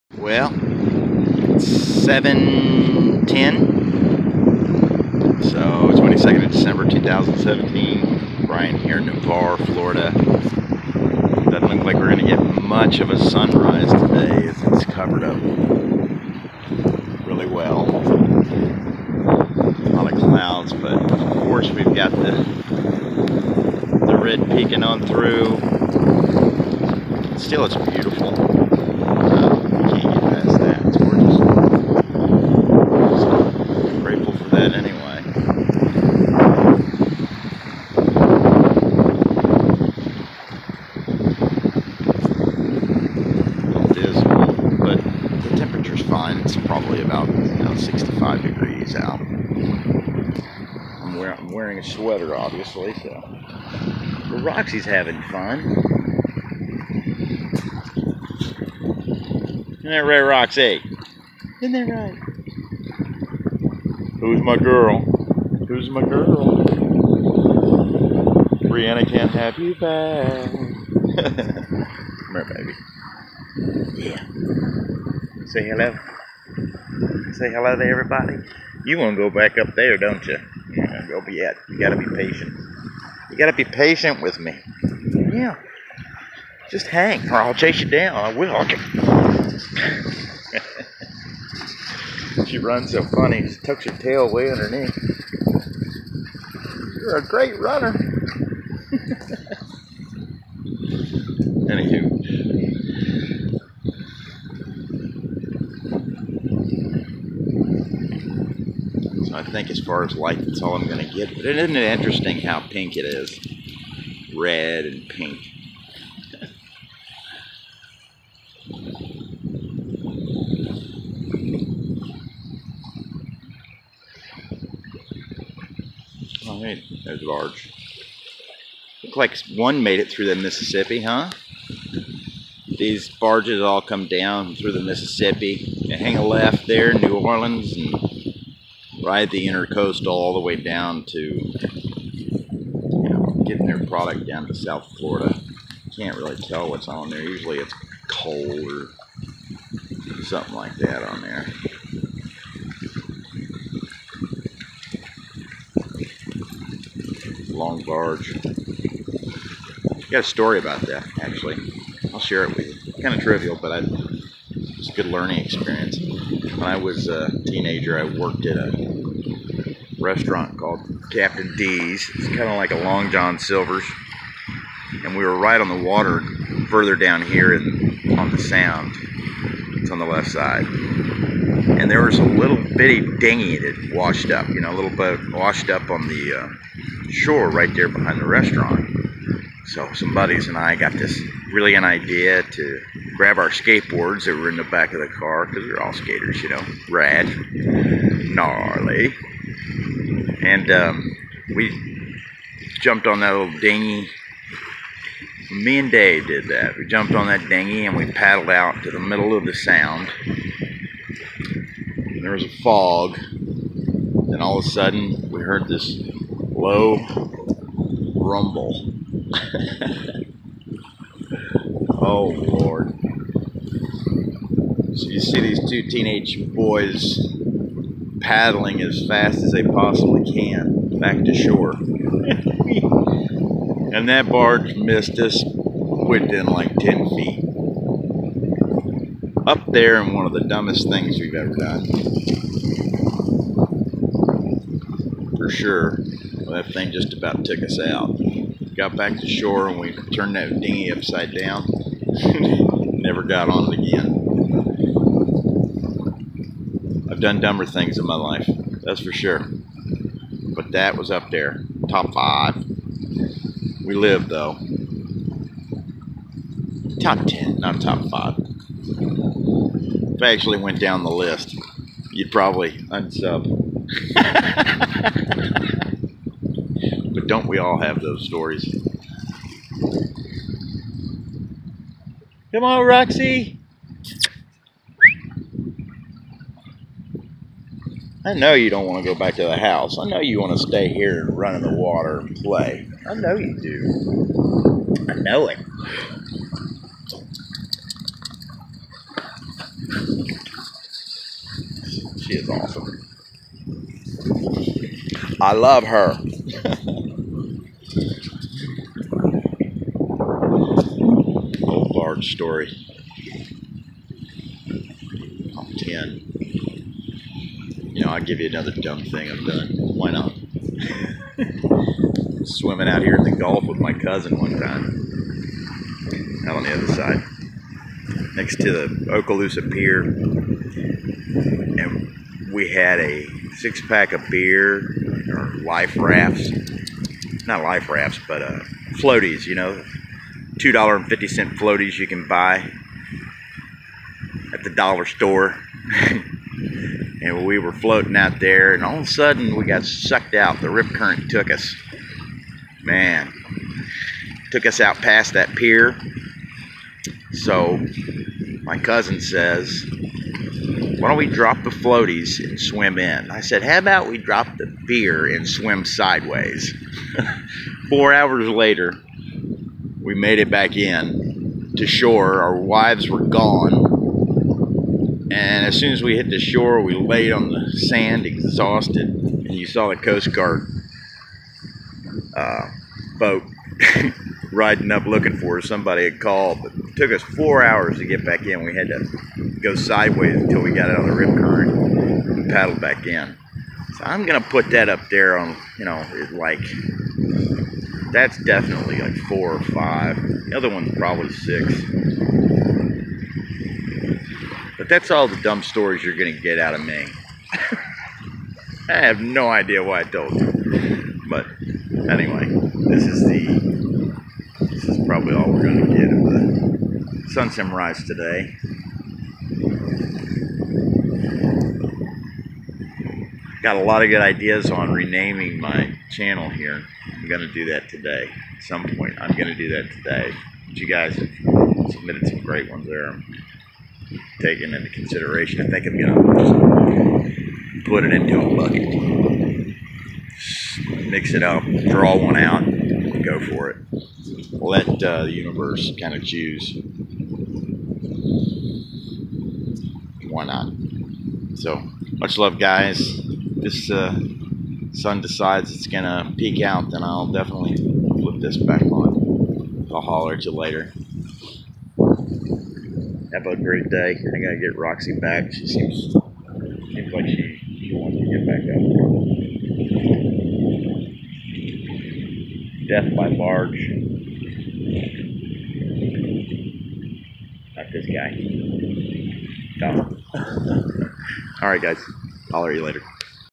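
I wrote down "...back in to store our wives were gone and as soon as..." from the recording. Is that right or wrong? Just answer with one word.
wrong.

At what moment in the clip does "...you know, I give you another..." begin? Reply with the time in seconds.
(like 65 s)
317 s.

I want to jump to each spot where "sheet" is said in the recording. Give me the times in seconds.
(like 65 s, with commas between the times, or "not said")
not said.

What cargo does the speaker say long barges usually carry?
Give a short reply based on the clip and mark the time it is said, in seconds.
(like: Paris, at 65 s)
Coal, at 148 s.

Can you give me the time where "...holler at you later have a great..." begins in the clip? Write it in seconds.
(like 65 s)
460 s.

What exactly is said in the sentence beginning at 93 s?
She tucks her tail way underneath.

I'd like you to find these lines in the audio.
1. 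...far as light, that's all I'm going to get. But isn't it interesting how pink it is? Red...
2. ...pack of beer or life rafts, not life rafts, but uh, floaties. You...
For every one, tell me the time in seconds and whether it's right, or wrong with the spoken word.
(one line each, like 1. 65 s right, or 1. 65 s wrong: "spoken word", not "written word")
1. 109 s right
2. 333 s right.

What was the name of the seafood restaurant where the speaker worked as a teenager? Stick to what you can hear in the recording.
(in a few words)
Captain D's.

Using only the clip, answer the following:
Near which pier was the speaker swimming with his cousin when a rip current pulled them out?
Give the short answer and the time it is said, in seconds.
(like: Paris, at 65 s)
Okaloosa Pier, at 329 s.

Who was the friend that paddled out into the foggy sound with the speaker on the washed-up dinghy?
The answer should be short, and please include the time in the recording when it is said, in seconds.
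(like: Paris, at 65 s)
Dave, at 205 s.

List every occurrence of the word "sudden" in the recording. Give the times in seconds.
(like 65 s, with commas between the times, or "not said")
214 s, 349 s.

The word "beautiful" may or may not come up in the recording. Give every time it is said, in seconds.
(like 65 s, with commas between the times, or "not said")
27 s.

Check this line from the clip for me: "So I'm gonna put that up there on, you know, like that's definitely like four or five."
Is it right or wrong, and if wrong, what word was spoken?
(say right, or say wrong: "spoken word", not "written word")
right.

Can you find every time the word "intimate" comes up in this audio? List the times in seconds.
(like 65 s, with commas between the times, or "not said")
not said.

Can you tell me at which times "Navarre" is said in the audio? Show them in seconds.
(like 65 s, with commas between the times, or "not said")
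9 s.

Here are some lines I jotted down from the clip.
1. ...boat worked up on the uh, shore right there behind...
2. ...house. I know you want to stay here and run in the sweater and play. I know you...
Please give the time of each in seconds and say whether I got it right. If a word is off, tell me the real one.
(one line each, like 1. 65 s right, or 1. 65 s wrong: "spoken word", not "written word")
1. 184 s wrong: "washed", not "worked"
2. 289 s wrong: "water", not "sweater".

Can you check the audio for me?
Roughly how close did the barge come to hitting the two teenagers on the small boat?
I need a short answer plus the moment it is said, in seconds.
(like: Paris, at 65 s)
10 feet, at 236 s.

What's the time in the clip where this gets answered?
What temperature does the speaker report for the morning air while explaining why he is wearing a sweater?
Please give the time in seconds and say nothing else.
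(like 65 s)
47 s.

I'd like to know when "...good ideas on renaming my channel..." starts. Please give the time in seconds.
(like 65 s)
424 s.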